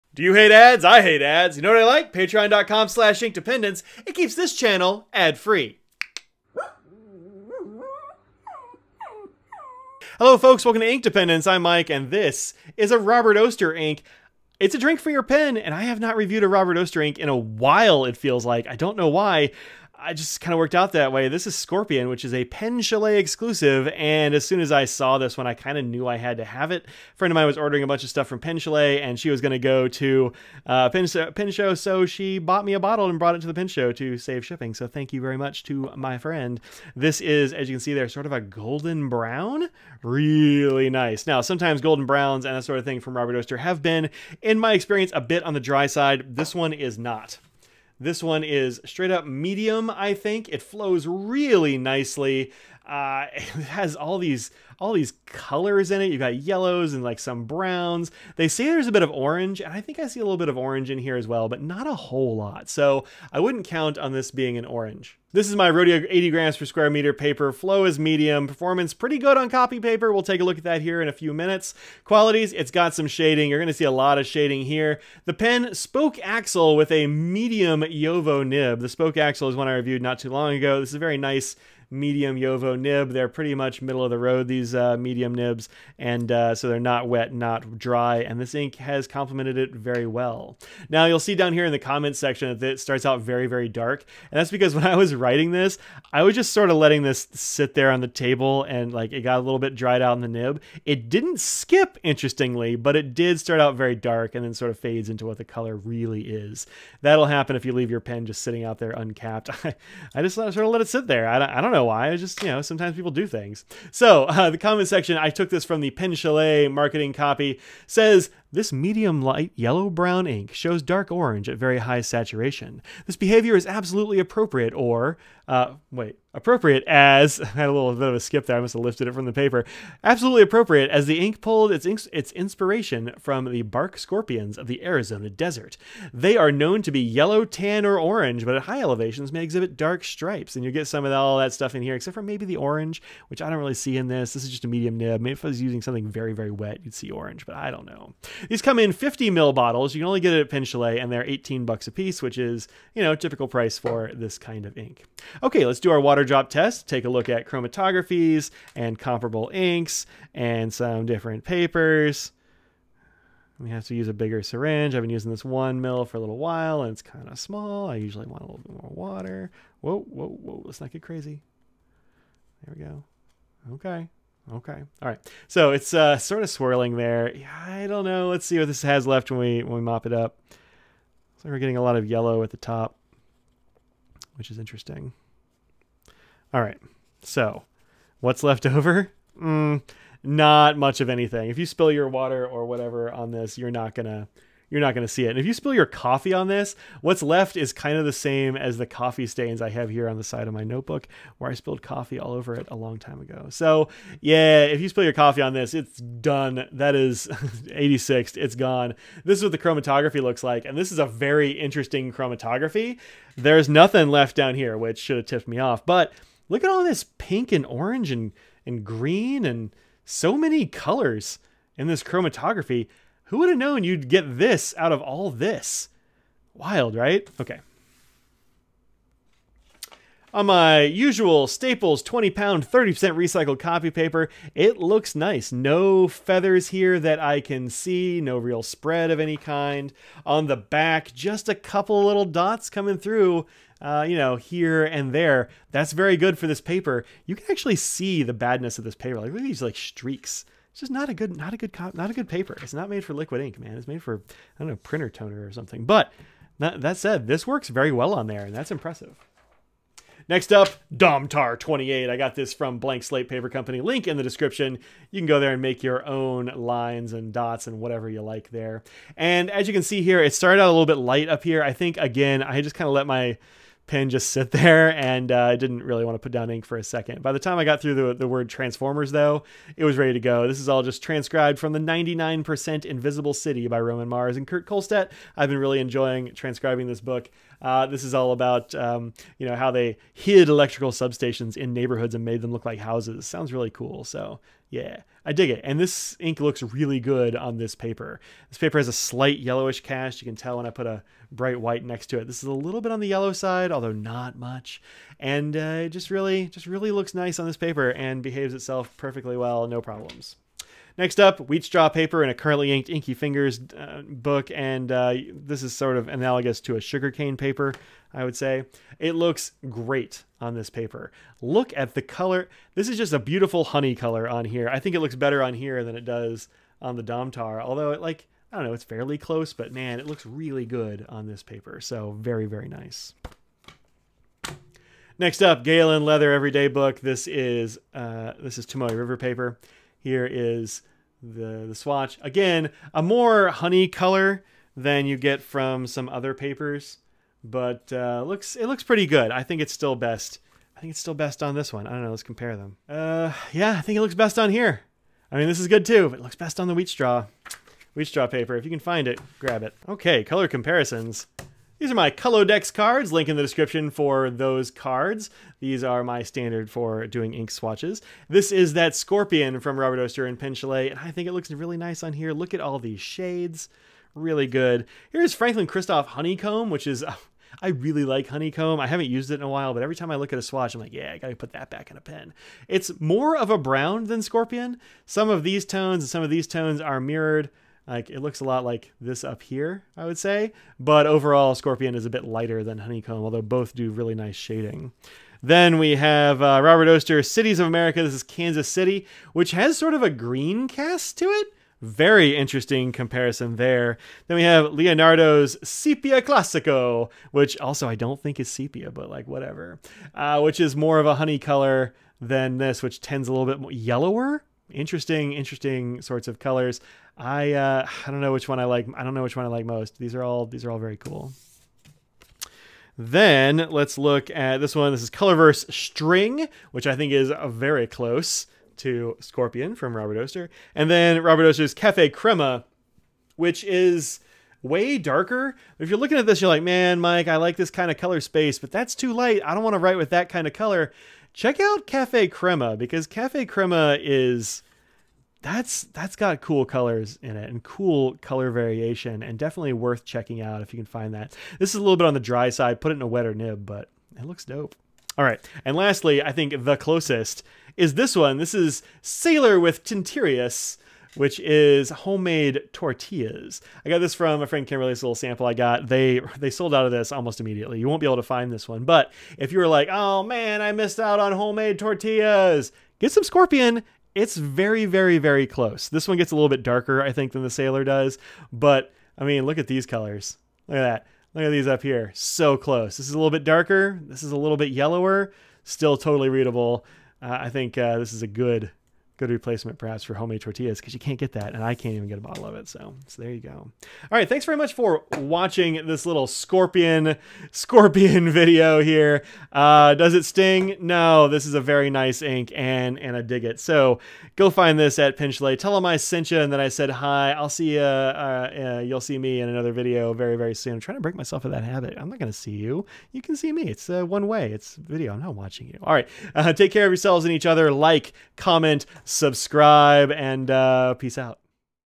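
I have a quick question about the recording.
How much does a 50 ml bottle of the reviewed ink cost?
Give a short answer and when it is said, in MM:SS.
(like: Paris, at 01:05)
18 dollars, at 02:31.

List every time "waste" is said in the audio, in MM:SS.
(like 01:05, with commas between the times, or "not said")
not said.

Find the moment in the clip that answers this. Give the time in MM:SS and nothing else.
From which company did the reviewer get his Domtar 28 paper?
04:22.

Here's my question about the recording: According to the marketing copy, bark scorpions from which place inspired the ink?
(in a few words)
Arizona.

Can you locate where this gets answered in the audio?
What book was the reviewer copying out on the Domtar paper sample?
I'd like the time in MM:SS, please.
04:41.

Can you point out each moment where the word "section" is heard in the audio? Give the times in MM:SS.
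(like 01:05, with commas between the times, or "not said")
01:32, 01:54.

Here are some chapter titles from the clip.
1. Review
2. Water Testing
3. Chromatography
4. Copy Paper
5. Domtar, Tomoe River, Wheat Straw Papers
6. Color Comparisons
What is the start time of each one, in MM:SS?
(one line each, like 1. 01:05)
1. 00:10
2. 02:36
3. 03:30
4. 03:50
5. 04:20
6. 06:02.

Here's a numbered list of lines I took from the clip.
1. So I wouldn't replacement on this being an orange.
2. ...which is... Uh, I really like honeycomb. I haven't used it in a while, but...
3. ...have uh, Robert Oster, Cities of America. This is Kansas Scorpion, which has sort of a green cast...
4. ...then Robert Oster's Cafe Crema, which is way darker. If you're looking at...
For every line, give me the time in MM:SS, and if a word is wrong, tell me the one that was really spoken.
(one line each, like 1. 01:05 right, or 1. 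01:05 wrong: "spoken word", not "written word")
1. 01:02 wrong: "count", not "replacement"
2. 06:16 right
3. 06:35 wrong: "City", not "Scorpion"
4. 07:10 right.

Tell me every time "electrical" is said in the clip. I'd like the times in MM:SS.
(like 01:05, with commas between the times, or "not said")
04:50.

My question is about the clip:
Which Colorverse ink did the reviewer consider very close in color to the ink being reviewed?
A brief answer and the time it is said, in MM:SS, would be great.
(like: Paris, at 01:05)
String, at 07:05.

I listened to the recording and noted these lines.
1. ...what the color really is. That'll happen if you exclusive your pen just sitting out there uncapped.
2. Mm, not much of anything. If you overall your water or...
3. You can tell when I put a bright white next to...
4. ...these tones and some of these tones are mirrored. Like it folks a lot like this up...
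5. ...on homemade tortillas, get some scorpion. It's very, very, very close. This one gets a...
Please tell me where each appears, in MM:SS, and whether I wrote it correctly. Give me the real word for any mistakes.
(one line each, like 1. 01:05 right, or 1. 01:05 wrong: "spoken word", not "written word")
1. 01:45 wrong: "leave", not "exclusive"
2. 03:09 wrong: "spill", not "overall"
3. 05:00 right
4. 06:25 wrong: "looks", not "folks"
5. 07:51 right.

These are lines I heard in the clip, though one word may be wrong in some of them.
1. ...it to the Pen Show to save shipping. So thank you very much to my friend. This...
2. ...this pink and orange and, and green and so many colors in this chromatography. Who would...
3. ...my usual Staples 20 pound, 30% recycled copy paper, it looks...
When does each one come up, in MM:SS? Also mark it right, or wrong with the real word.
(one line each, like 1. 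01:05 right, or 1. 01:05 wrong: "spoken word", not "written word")
1. 00:33 right
2. 03:36 right
3. 03:50 right.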